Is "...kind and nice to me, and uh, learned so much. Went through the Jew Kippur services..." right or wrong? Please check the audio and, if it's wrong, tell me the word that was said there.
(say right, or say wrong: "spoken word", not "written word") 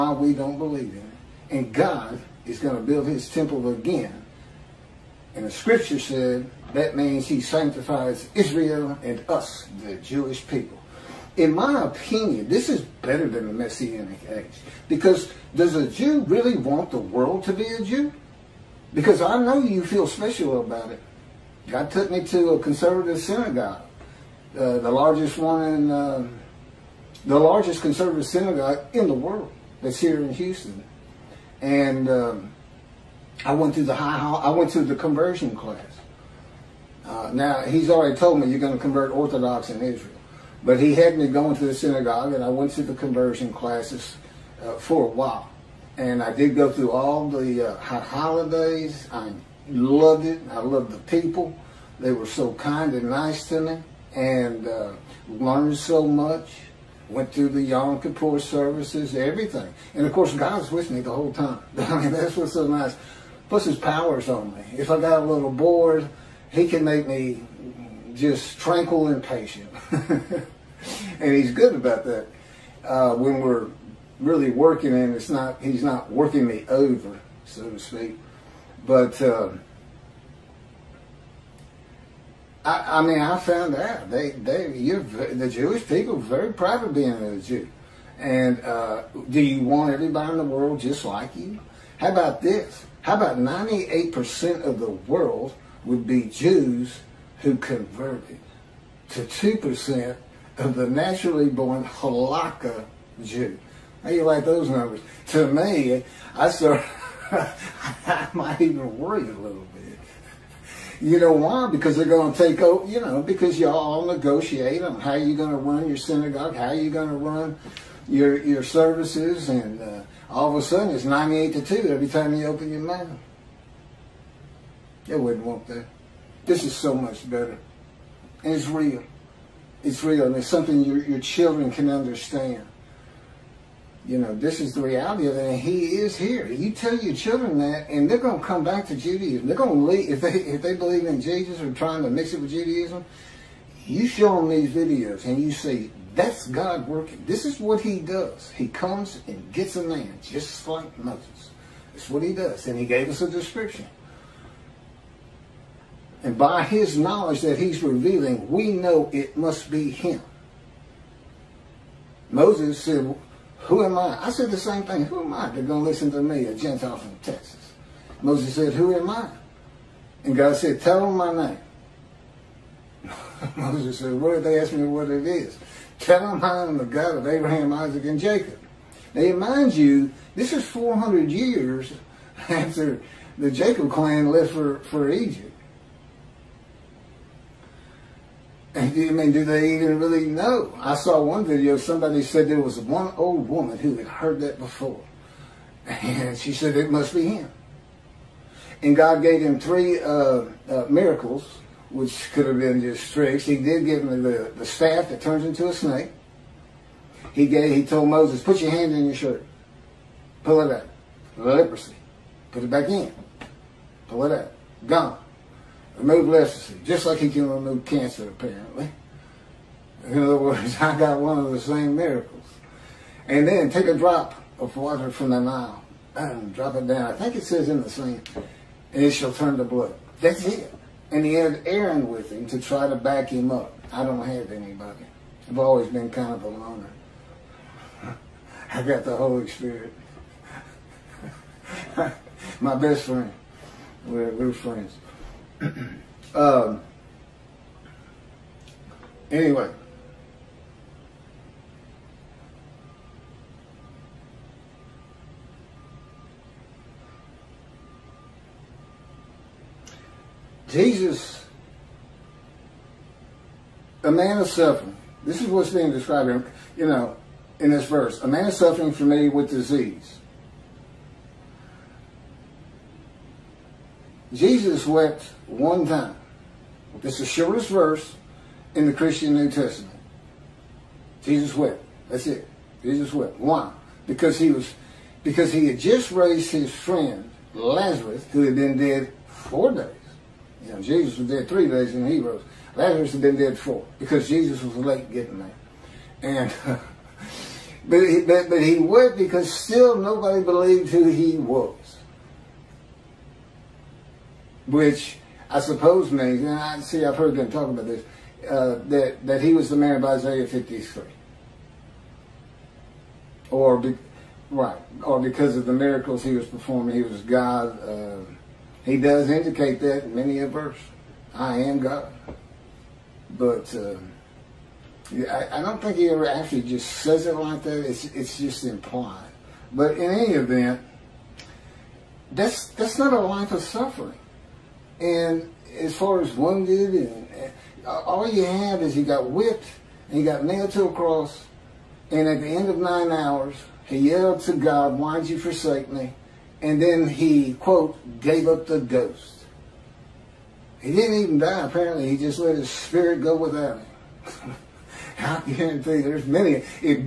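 wrong: "Yom", not "Jew".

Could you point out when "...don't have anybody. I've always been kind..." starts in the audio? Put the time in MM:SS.
03:54.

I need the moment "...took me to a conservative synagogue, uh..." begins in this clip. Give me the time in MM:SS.
00:21.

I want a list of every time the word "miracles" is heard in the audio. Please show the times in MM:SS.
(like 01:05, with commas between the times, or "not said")
03:20, 03:41, 05:15.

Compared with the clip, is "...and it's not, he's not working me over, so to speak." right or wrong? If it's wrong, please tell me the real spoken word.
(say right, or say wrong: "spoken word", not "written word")
right.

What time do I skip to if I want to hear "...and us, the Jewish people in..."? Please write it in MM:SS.
00:09.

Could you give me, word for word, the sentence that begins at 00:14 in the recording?
Because does a Jew really want the world to be a Jew?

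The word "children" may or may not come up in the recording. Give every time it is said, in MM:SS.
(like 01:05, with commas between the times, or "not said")
02:11, 02:17.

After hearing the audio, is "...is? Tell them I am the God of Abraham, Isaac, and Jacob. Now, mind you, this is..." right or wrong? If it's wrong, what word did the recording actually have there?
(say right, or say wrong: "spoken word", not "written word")
right.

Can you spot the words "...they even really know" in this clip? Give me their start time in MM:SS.
03:09.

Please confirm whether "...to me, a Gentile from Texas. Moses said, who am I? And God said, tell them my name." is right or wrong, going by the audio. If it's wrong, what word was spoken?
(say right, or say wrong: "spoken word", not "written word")
right.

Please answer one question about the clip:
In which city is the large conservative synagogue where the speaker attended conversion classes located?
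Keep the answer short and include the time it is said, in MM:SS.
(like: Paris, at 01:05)
Houston, at 00:30.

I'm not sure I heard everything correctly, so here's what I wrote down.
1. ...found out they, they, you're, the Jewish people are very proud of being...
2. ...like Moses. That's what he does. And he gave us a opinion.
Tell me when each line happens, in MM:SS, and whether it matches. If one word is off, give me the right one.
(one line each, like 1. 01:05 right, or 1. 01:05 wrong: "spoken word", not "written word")
1. 01:23 right
2. 02:30 wrong: "description", not "opinion".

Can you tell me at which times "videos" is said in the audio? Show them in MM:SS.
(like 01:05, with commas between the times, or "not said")
02:24, 03:11.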